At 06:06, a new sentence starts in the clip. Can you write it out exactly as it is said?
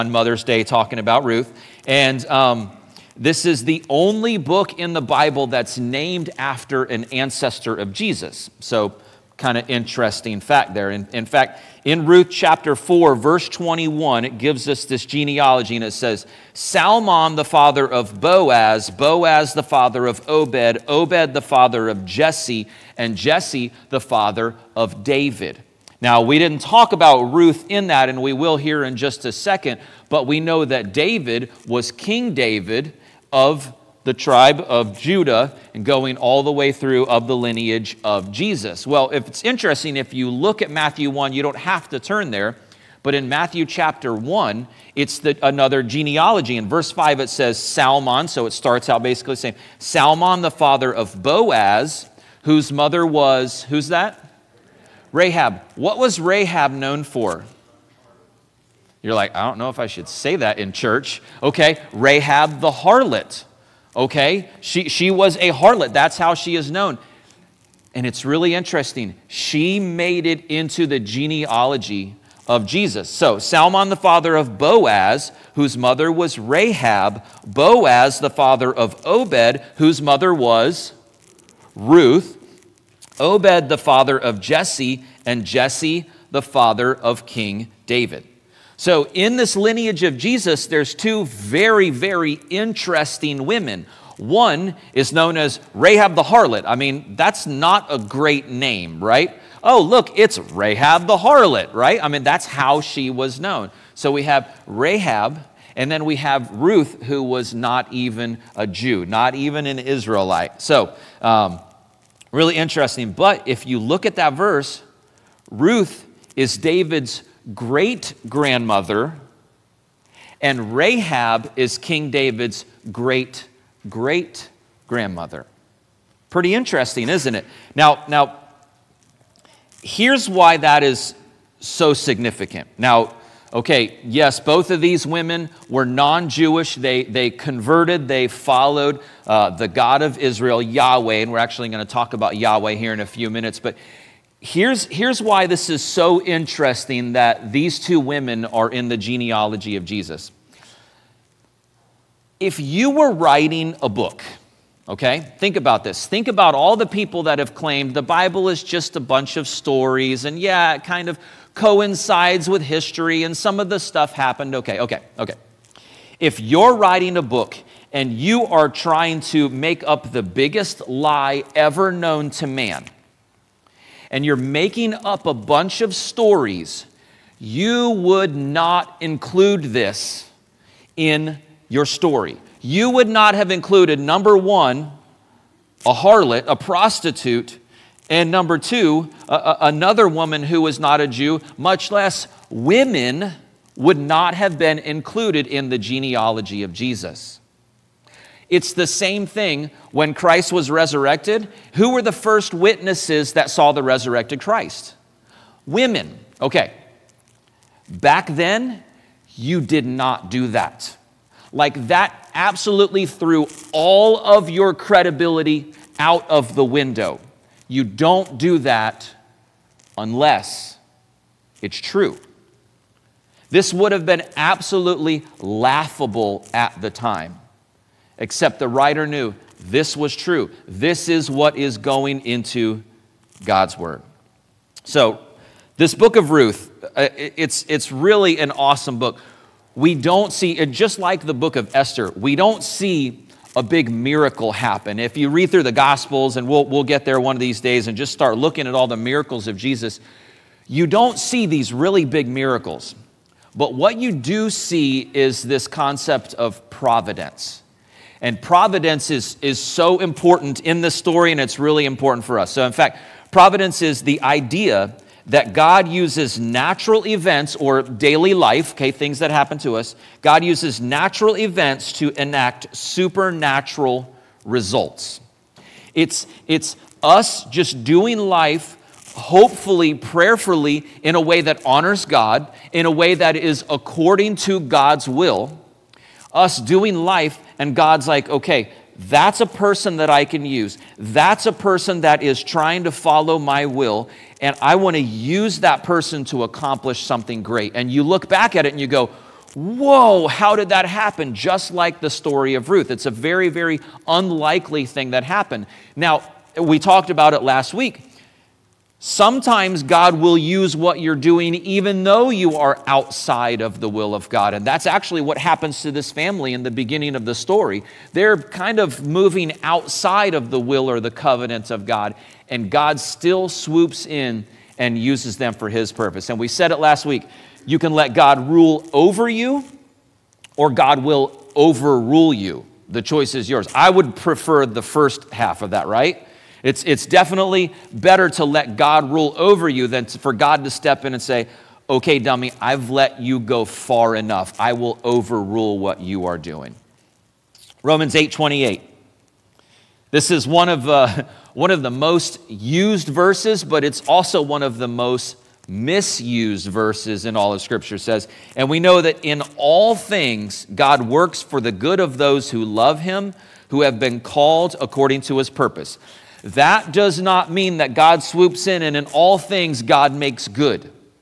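That does not mean that God swoops in and in all things God makes good.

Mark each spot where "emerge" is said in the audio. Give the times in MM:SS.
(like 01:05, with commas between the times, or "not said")
not said.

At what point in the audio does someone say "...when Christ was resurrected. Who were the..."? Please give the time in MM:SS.
03:19.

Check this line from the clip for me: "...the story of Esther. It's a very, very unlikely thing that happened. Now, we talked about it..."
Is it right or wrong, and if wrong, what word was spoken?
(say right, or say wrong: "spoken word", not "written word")
wrong: "Ruth", not "Esther".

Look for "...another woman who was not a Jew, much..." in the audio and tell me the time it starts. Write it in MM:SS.
03:09.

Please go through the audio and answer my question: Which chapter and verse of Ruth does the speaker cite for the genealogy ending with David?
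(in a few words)
Ruth 4:21.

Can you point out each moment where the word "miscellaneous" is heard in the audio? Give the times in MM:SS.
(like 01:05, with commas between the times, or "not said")
not said.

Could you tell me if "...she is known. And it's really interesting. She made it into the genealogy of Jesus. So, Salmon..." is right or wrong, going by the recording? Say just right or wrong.
right.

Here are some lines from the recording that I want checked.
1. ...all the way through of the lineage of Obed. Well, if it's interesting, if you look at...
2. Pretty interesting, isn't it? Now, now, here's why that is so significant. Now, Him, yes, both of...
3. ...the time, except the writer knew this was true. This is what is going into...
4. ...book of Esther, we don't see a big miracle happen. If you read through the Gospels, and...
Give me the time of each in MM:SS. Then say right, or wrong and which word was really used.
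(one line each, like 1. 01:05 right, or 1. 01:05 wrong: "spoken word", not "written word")
1. 00:36 wrong: "Jesus", not "Obed"
2. 02:06 wrong: "Okay", not "Him"
3. 03:46 right
4. 04:01 right.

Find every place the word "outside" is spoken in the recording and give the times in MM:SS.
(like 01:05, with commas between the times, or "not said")
05:12, 05:19.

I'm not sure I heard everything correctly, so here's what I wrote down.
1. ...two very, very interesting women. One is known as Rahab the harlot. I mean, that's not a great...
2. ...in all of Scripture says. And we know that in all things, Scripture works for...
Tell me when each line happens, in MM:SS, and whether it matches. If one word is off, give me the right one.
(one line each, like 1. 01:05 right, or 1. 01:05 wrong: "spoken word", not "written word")
1. 01:30 right
2. 05:57 wrong: "God", not "Scripture".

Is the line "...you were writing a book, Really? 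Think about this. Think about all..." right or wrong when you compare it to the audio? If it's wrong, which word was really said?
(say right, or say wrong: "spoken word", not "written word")
wrong: "Okay", not "Really".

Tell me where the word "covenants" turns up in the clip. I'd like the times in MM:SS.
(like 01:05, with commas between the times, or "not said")
05:21.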